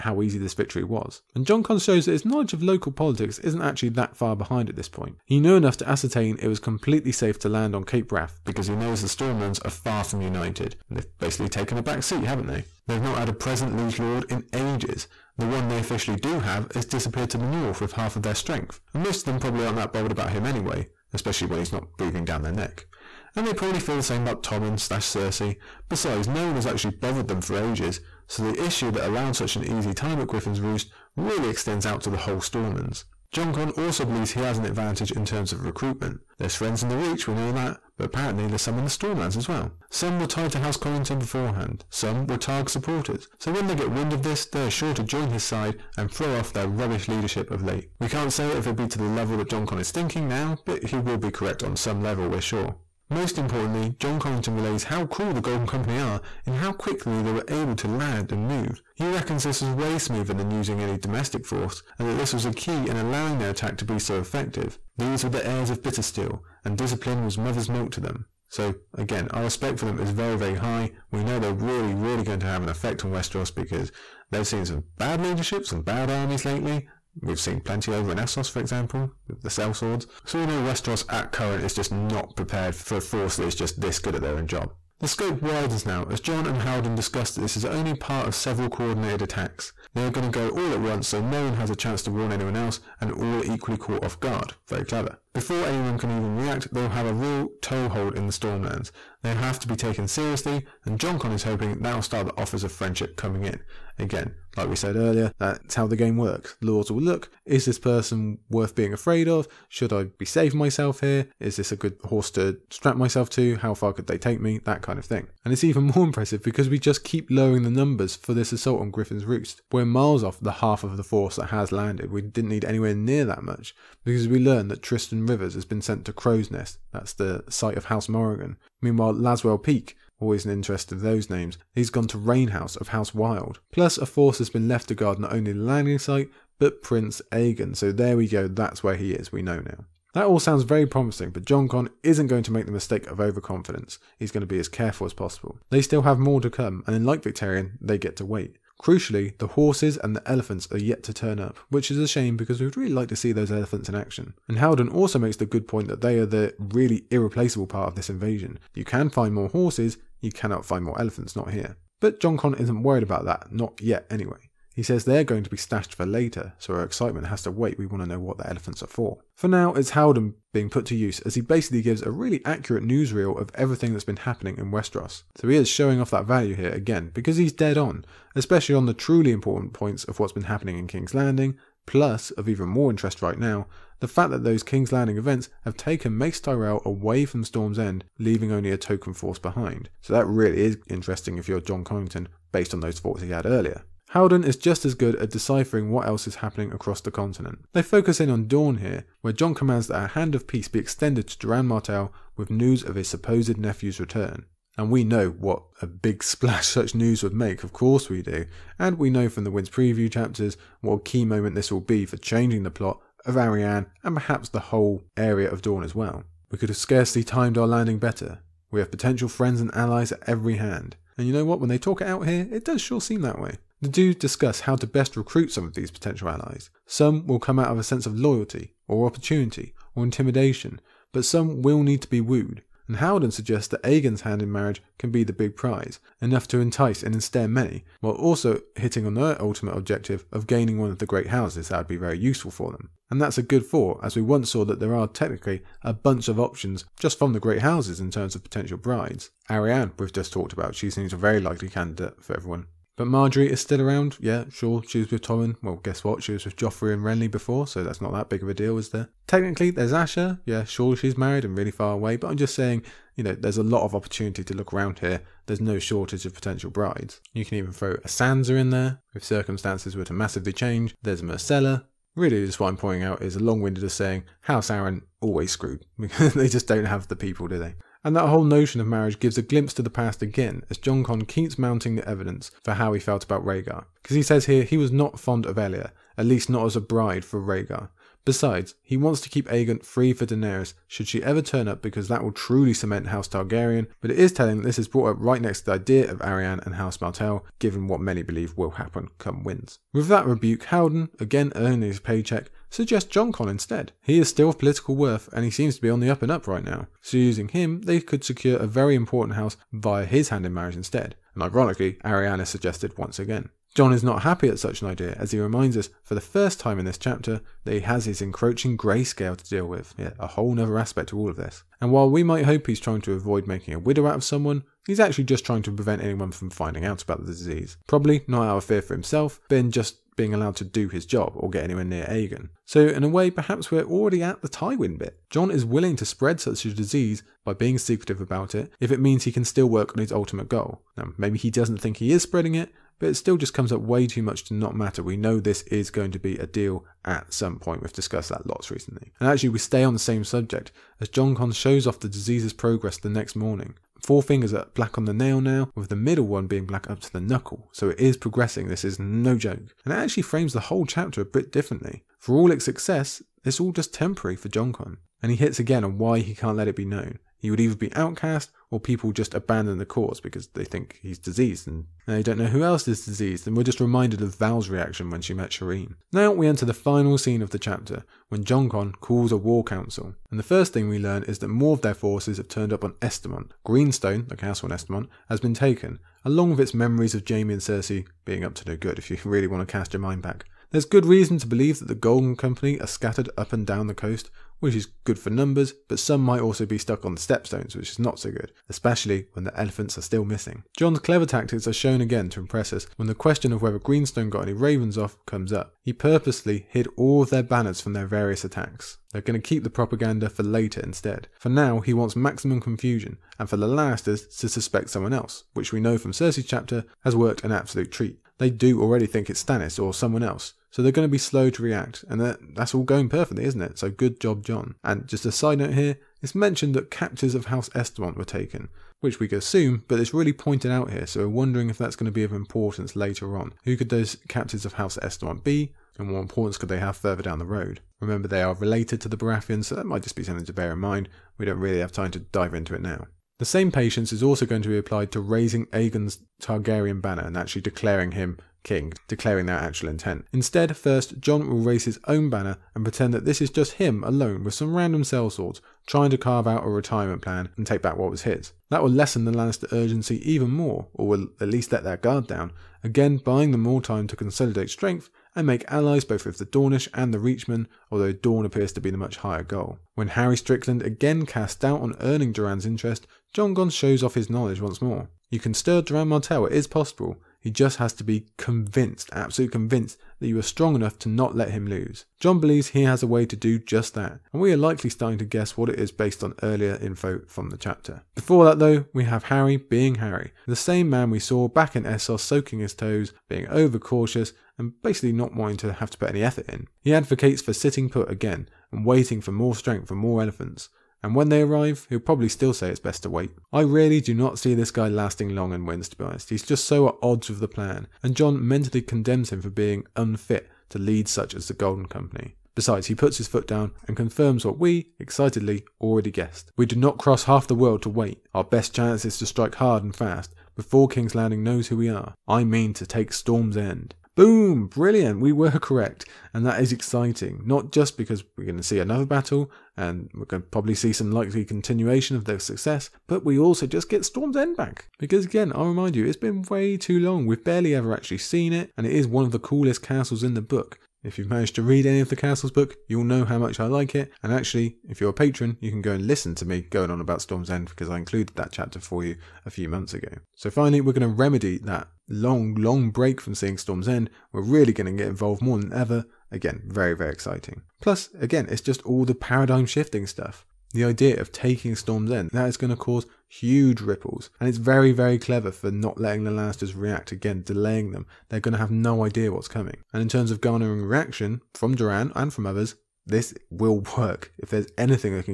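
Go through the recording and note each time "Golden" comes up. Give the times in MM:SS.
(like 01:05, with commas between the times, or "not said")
00:55, 06:31, 08:31.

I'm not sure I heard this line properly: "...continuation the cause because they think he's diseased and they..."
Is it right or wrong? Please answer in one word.
wrong.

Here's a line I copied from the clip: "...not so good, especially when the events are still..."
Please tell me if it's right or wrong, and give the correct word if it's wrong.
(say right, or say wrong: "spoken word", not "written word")
wrong: "elephants", not "events".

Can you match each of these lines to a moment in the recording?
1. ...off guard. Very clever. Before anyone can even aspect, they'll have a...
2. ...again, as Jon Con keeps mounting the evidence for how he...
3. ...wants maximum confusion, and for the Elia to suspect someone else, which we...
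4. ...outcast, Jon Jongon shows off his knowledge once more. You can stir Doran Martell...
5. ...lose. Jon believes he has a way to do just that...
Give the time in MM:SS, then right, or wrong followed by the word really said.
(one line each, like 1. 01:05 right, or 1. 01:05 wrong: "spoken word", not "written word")
1. 01:34 wrong: "react", not "aspect"
2. 04:40 right
3. 06:51 wrong: "Lannisters", not "Elia"
4. 07:52 wrong: "interest", not "outcast"
5. 08:01 right.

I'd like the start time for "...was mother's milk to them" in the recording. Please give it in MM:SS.
01:07.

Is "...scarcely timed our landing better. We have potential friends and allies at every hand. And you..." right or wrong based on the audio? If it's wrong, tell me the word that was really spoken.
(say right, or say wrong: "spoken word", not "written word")
right.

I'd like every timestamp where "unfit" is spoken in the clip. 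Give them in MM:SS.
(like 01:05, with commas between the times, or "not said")
08:29.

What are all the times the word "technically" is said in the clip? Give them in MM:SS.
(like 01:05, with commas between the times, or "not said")
04:05, 04:19.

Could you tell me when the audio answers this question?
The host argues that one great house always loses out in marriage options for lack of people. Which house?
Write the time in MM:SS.
04:34.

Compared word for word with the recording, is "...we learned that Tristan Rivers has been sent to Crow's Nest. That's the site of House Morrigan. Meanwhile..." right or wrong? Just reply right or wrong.
right.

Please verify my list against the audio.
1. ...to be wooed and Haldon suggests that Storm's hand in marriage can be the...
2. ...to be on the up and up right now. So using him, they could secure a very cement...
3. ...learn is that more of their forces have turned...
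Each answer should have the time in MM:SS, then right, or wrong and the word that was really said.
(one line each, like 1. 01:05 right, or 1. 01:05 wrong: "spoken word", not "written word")
1. 03:52 wrong: "Aegon", not "Storm"
2. 05:05 wrong: "important", not "cement"
3. 06:20 right.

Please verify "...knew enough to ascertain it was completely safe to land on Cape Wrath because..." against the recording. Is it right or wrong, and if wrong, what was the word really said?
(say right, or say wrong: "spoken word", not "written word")
right.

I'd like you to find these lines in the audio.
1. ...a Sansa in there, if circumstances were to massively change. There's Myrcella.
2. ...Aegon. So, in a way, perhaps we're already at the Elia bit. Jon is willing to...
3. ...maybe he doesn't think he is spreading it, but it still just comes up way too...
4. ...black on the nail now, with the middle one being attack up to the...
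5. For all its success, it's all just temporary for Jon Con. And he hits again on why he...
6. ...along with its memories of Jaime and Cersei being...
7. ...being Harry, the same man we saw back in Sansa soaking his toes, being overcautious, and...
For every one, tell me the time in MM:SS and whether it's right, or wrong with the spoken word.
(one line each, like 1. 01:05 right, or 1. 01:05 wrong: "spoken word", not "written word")
1. 04:27 right
2. 05:32 wrong: "Tywin", not "Elia"
3. 05:41 right
4. 05:54 wrong: "black", not "attack"
5. 06:02 right
6. 06:26 right
7. 08:09 wrong: "Essos", not "Sansa".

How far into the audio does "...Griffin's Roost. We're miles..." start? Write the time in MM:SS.
01:58.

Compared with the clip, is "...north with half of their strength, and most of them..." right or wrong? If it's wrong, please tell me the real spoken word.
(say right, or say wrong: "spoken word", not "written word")
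right.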